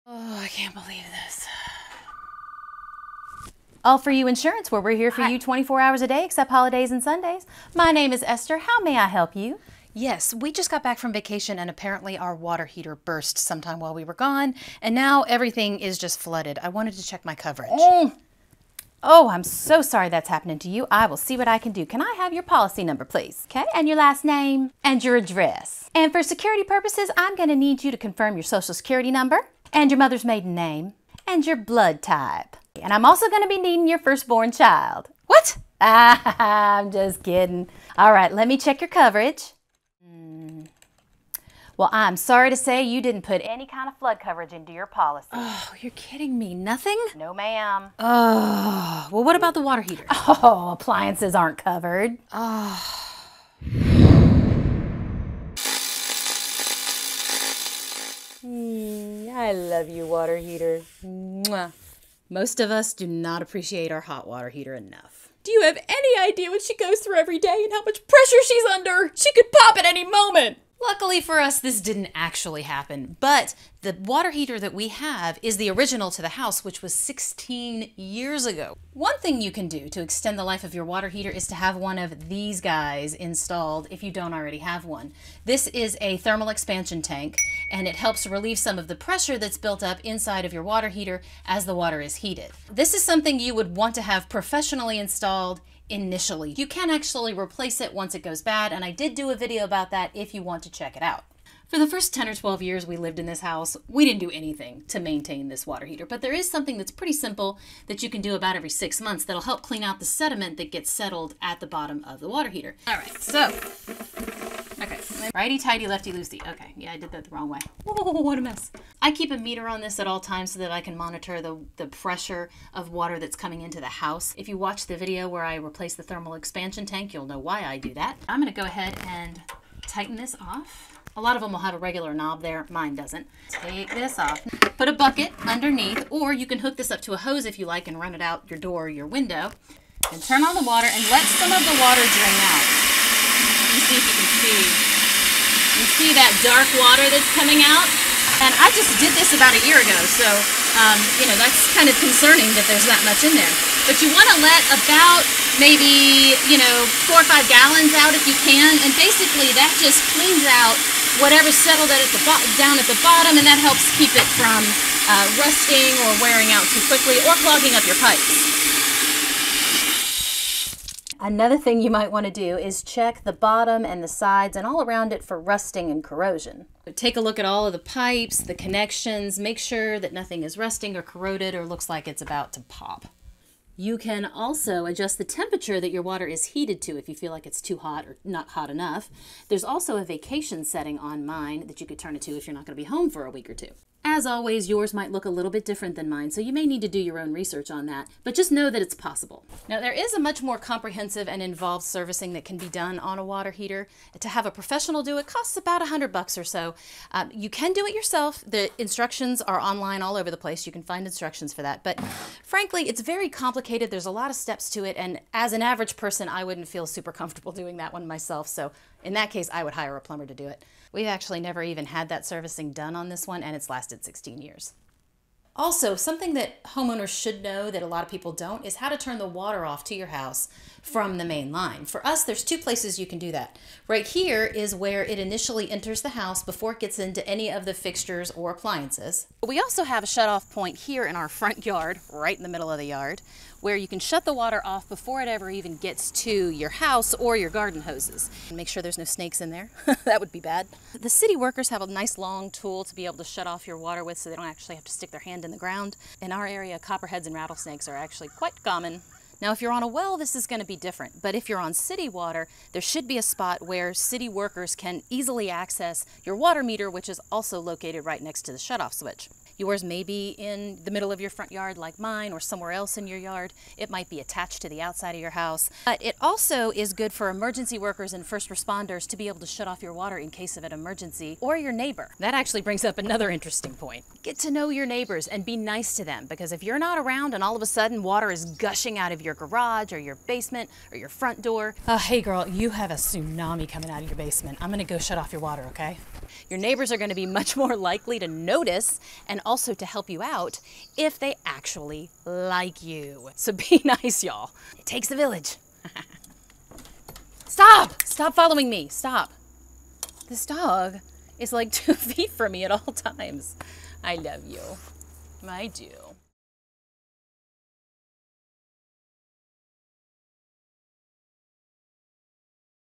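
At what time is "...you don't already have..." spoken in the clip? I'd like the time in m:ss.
1:24.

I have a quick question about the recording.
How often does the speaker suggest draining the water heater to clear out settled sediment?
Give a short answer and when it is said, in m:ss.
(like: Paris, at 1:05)
Every six months, at 1:48.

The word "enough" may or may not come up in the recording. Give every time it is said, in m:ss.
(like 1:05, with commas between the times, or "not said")
1:04, 3:08.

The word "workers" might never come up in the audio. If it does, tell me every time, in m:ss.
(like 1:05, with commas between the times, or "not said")
4:11, 4:24, 4:37.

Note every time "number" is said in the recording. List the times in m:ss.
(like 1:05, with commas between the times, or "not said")
0:22, 0:29.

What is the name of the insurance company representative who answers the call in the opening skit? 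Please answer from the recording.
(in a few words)
Esther.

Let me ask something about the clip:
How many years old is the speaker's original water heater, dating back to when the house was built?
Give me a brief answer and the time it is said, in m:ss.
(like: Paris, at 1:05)
16 years, at 1:16.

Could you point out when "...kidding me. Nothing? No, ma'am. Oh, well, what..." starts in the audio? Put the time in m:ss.
0:45.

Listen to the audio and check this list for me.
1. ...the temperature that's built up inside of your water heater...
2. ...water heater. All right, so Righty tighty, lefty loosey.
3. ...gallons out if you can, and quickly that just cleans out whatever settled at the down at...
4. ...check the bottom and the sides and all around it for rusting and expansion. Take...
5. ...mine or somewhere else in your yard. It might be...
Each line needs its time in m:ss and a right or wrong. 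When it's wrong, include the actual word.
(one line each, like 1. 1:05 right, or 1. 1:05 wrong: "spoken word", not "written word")
1. 1:28 wrong: "pressure", not "temperature"
2. 1:52 right
3. 2:37 wrong: "basically", not "quickly"
4. 2:52 wrong: "corrosion", not "expansion"
5. 4:31 right.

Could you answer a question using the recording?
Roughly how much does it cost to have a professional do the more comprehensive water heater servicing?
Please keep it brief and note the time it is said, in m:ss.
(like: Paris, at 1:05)
$100, at 3:25.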